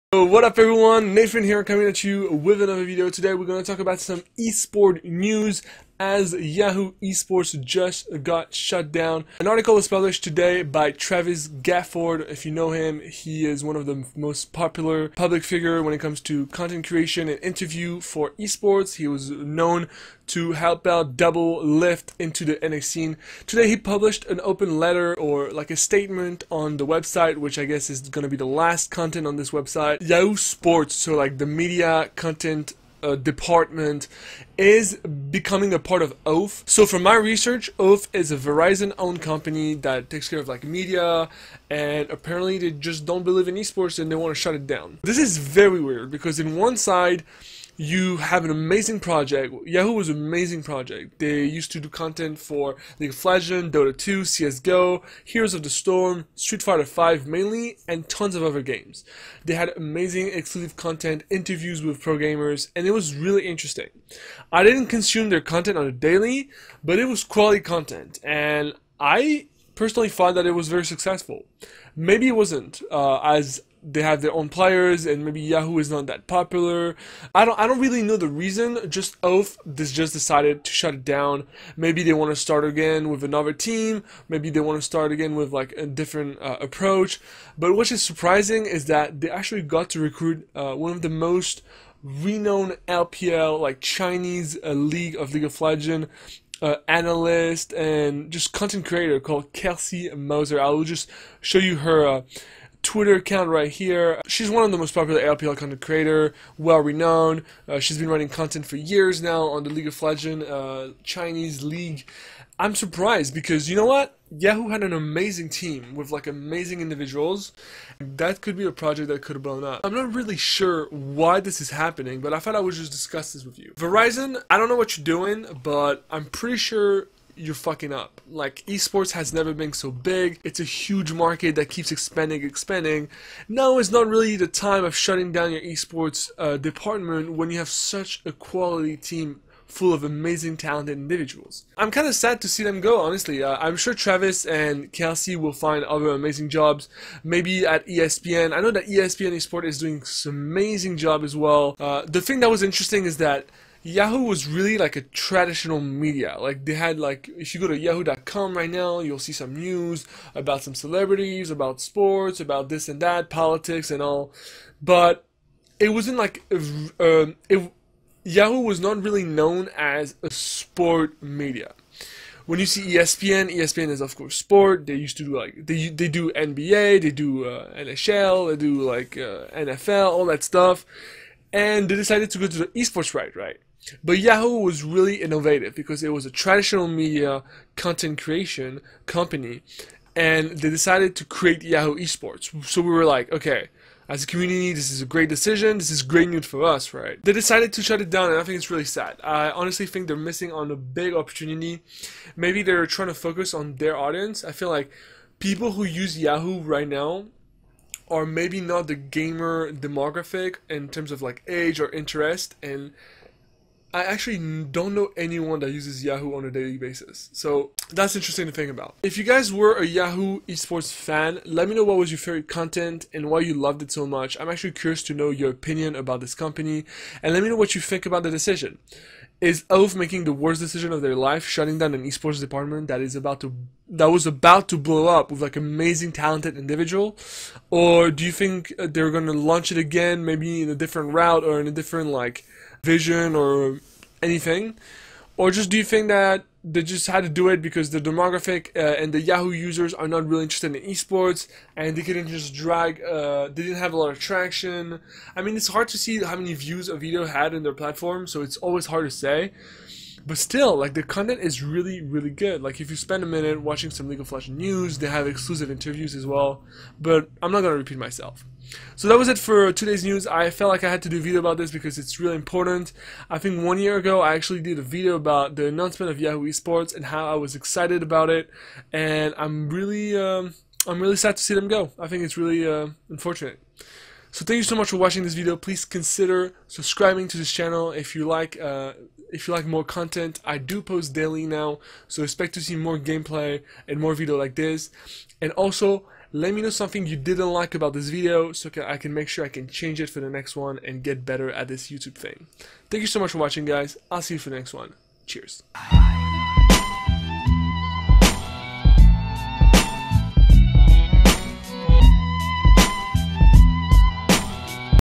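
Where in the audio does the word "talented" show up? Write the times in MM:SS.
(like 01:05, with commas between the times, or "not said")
02:20, 03:56.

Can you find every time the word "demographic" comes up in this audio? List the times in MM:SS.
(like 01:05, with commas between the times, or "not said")
03:29, 04:07.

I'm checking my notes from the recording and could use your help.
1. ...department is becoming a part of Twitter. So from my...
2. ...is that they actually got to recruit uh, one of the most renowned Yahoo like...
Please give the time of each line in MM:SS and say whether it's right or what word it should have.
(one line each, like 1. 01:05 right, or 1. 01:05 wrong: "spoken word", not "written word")
1. 00:33 wrong: "Oath", not "Twitter"
2. 01:28 wrong: "LPL", not "Yahoo".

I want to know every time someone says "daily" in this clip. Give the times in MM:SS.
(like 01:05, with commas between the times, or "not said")
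01:05, 03:36, 04:51.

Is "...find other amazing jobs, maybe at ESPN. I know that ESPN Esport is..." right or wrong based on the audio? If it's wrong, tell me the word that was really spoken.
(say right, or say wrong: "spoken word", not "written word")
right.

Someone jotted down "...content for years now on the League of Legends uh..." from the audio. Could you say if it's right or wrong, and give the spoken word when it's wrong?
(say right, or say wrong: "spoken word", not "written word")
right.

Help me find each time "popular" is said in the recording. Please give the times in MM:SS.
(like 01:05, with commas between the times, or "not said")
00:14, 01:16, 01:44.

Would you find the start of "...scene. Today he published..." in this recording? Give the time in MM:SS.
00:22.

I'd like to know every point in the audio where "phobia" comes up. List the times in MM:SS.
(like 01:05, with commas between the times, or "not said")
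not said.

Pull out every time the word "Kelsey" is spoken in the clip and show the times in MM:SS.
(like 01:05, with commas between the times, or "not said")
01:39, 02:24.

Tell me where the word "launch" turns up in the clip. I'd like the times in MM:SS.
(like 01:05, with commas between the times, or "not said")
03:59.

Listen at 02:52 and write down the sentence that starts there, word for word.
When you see ESPN, ESPN is of course sport.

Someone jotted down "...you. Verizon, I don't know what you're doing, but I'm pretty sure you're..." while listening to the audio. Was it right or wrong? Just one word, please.
right.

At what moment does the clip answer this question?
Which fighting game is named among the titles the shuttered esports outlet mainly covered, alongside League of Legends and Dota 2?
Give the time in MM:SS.
00:56.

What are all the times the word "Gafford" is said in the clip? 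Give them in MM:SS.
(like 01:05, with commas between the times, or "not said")
00:11.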